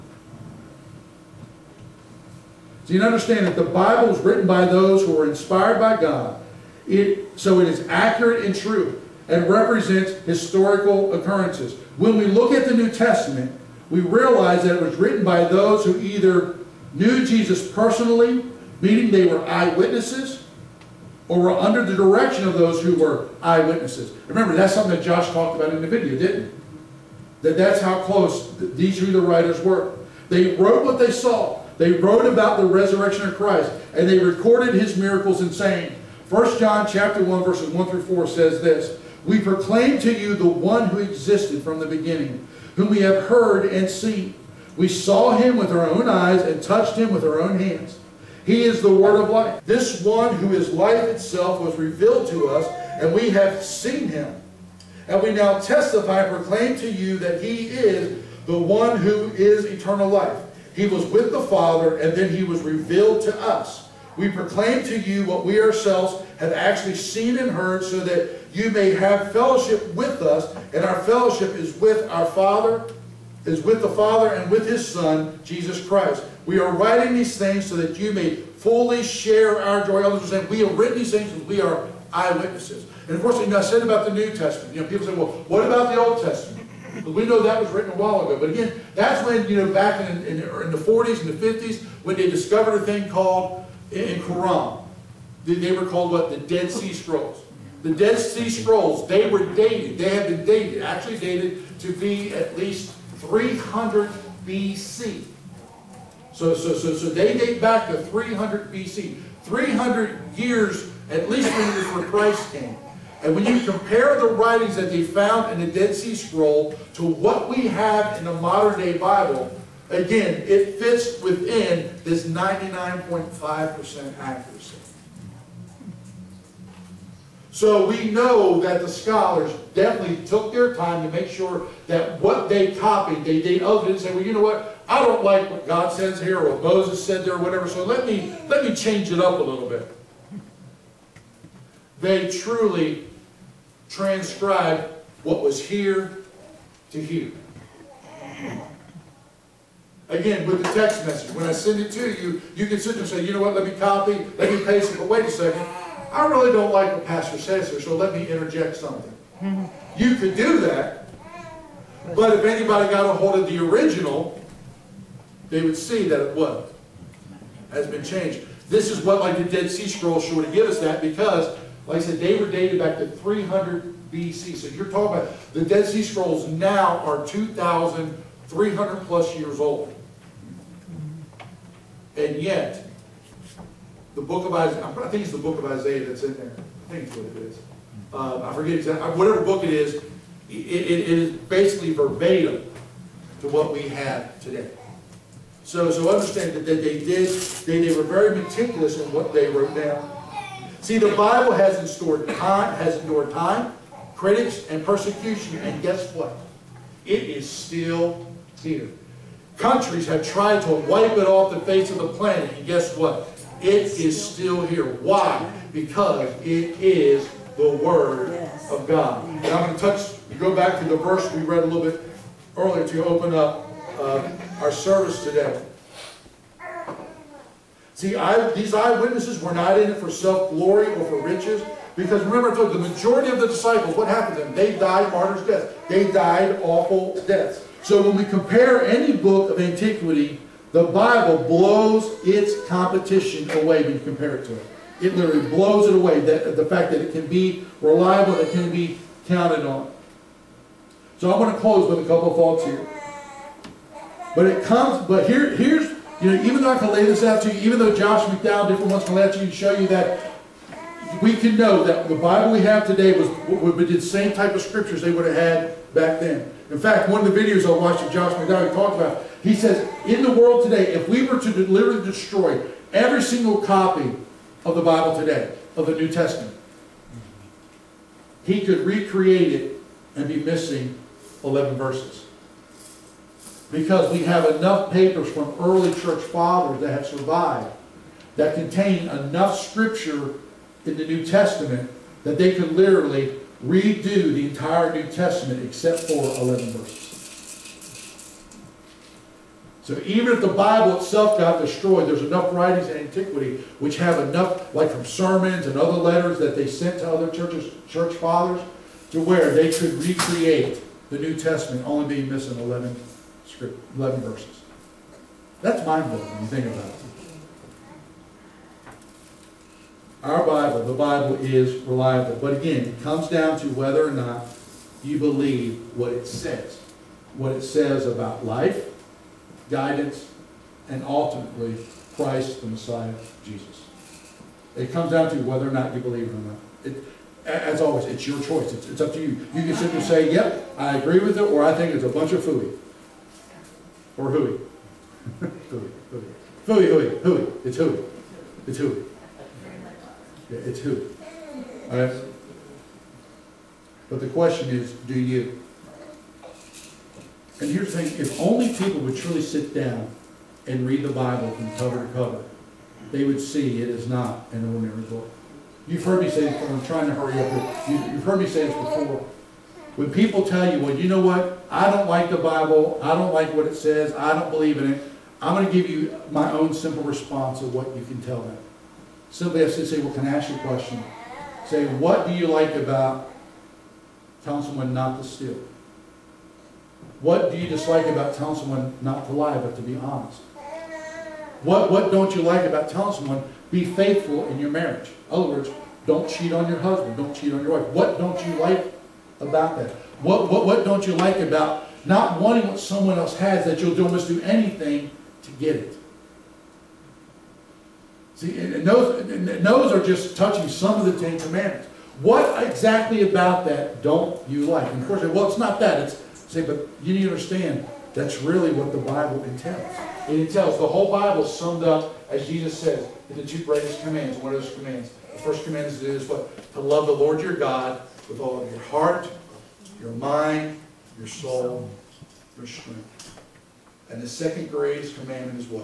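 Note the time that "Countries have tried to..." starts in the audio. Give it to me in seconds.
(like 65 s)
209 s.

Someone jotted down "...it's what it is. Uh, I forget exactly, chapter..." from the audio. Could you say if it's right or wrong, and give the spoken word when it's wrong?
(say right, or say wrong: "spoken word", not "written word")
wrong: "whatever", not "chapter".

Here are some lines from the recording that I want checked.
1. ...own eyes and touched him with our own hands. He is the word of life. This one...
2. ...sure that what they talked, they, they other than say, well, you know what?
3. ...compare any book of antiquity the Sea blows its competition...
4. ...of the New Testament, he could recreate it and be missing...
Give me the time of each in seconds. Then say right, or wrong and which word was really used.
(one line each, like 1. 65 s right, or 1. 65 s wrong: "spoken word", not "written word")
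1. 45 s right
2. 131 s wrong: "copied", not "talked"
3. 238 s wrong: "Bible", not "Sea"
4. 275 s right.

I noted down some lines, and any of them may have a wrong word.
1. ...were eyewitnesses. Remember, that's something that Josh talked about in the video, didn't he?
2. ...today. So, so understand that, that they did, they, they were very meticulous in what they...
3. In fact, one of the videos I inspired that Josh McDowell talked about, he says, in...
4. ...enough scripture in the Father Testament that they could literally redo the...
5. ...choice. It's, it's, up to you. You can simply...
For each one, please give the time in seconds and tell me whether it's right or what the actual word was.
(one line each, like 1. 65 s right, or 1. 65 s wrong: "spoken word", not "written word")
1. 22 s right
2. 194 s right
3. 266 s wrong: "watched", not "inspired"
4. 289 s wrong: "New", not "Father"
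5. 338 s right.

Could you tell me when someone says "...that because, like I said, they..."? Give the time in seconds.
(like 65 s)
170 s.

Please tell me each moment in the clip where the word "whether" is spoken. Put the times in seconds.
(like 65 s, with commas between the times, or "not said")
323 s, 335 s.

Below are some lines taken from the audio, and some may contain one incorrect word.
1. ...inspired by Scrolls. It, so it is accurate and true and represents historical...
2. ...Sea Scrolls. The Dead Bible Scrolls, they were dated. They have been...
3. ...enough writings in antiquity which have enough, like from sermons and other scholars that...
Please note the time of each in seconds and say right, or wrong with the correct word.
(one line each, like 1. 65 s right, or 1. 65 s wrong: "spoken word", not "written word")
1. 5 s wrong: "God", not "Scrolls"
2. 96 s wrong: "Sea", not "Bible"
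3. 302 s wrong: "letters", not "scholars".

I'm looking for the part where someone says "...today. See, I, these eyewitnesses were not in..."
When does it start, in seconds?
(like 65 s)
225 s.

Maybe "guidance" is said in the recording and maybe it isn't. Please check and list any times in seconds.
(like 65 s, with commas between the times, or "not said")
329 s.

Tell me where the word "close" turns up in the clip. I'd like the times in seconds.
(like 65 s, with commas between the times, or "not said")
28 s, 251 s.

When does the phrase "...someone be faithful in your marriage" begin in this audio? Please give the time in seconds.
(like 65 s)
393 s.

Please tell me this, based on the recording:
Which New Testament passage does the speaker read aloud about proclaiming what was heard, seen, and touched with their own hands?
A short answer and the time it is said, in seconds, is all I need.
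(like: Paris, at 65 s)
1 John 1:1-4, at 36 s.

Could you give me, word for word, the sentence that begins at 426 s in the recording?
To love the Lord your God with all of your heart, your mind, your soul, your strength.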